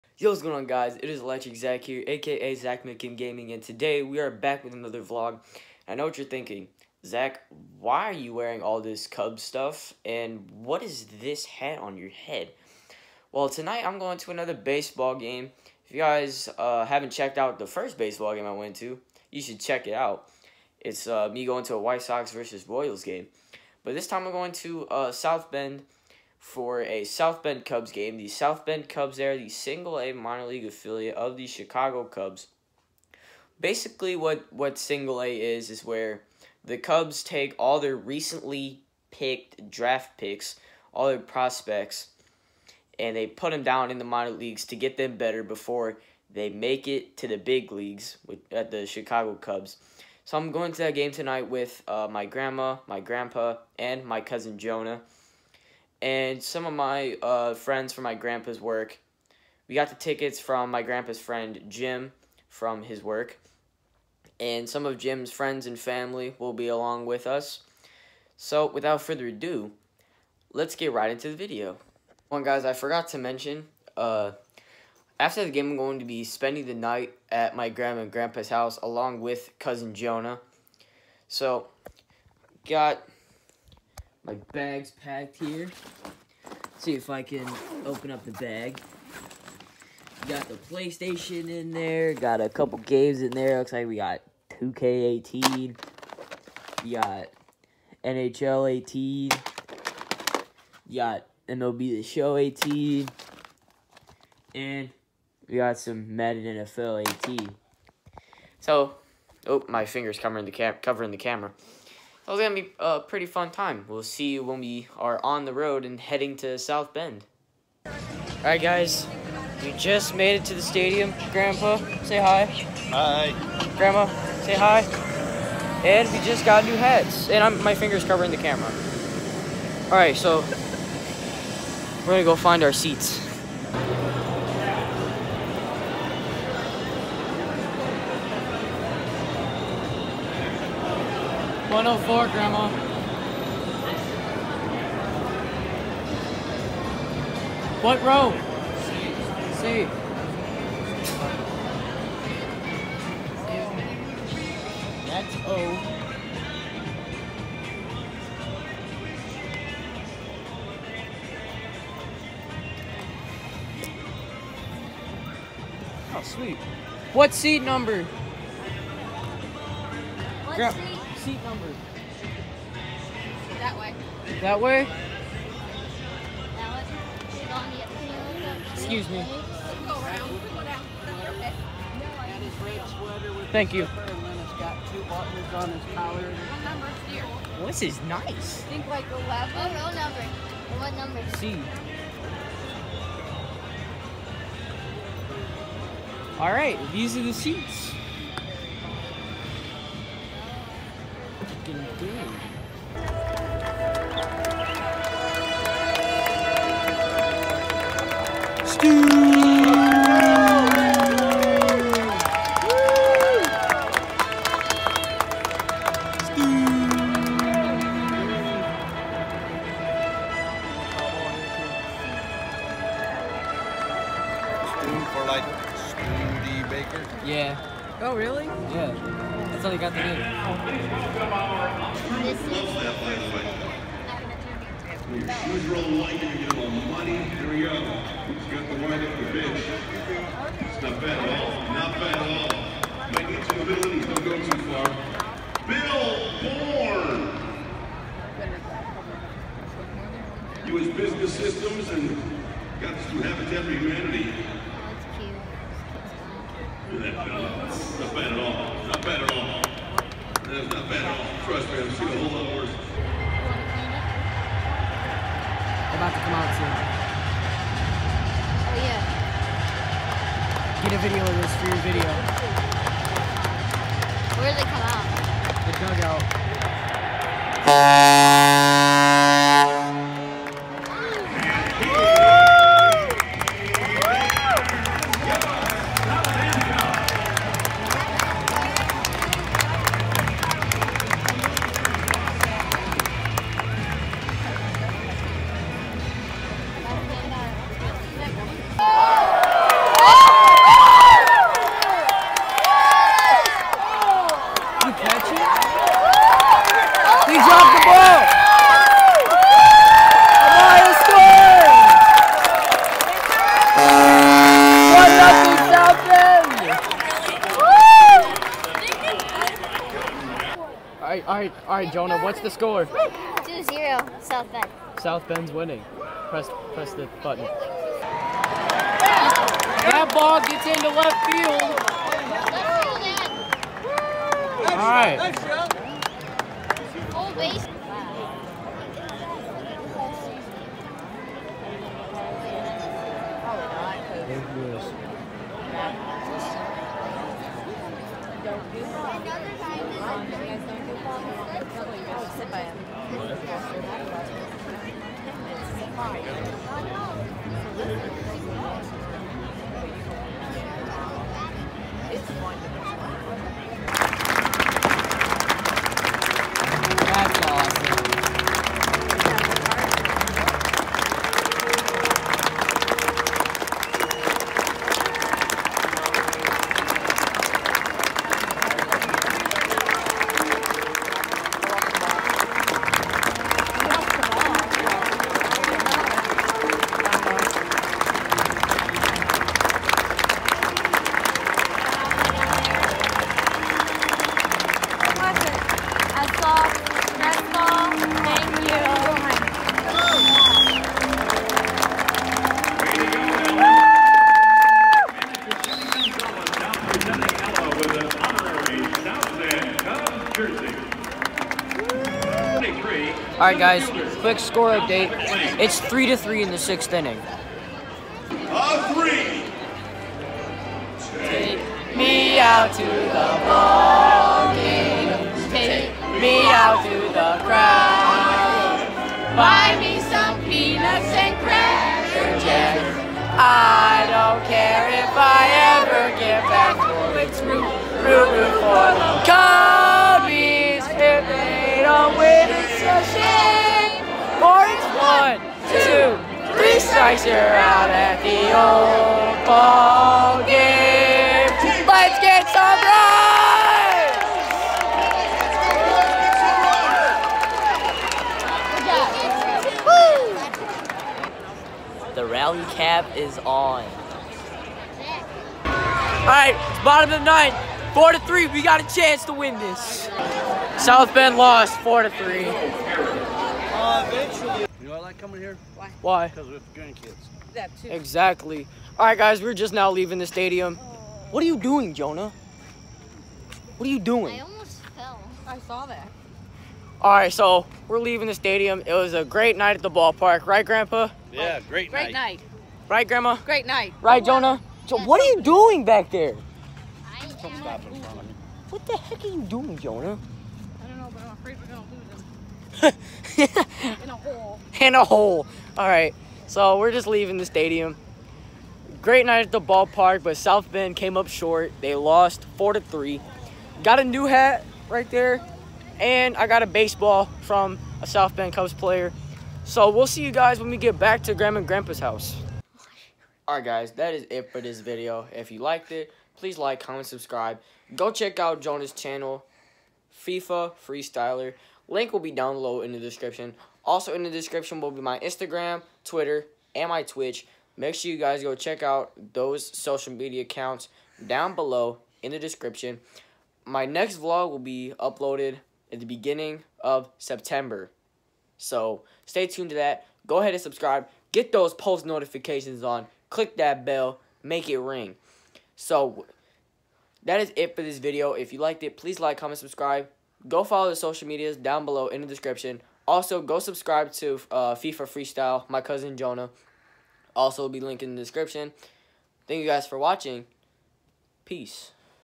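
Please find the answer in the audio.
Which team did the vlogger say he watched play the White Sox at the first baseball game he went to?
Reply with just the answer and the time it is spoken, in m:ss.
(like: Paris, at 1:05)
Royals, at 0:22.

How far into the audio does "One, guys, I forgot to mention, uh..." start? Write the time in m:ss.
1:12.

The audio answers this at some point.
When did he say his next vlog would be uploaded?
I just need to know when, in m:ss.
9:06.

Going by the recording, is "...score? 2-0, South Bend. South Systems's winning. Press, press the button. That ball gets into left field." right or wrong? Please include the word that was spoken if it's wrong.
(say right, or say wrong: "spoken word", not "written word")
wrong: "Bend", not "Systems".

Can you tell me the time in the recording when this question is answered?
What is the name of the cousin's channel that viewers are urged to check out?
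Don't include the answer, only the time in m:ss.
8:50.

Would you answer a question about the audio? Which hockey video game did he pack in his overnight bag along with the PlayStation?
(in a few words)
NHL 18.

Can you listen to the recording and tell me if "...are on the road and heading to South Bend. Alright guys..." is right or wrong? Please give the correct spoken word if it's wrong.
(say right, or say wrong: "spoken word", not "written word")
right.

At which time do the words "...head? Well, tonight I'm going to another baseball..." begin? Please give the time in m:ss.
0:12.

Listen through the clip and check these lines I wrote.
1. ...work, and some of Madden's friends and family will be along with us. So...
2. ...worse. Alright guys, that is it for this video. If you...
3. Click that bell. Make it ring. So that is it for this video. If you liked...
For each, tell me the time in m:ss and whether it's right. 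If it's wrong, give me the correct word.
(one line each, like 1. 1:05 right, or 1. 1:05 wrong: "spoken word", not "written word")
1. 1:03 wrong: "Jim", not "Madden"
2. 8:41 wrong: "house", not "worse"
3. 9:13 right.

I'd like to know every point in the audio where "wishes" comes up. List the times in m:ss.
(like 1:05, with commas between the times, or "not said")
not said.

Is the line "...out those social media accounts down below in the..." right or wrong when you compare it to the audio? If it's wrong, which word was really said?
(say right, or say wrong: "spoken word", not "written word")
right.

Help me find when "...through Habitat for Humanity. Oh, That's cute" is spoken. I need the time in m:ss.
4:13.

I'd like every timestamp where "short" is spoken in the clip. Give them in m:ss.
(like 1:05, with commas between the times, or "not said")
8:31.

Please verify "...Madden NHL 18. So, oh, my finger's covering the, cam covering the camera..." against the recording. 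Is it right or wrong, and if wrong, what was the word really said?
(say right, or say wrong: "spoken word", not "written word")
wrong: "NFL", not "NHL".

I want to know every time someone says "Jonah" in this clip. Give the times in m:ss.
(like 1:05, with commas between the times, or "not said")
0:54, 1:19, 5:21, 8:01, 8:14, 8:19, 8:48, 9:26.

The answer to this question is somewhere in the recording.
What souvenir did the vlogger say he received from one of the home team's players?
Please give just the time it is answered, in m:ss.
8:36.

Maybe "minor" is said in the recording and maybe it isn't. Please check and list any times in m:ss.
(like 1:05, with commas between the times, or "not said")
0:30, 0:44.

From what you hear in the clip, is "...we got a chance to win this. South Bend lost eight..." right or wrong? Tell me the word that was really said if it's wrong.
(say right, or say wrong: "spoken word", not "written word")
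wrong: "four", not "eight".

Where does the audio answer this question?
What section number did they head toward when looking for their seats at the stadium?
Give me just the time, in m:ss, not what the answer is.
2:21.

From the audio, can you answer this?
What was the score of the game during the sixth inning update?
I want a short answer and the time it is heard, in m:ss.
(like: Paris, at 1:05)
3 to 3, at 6:55.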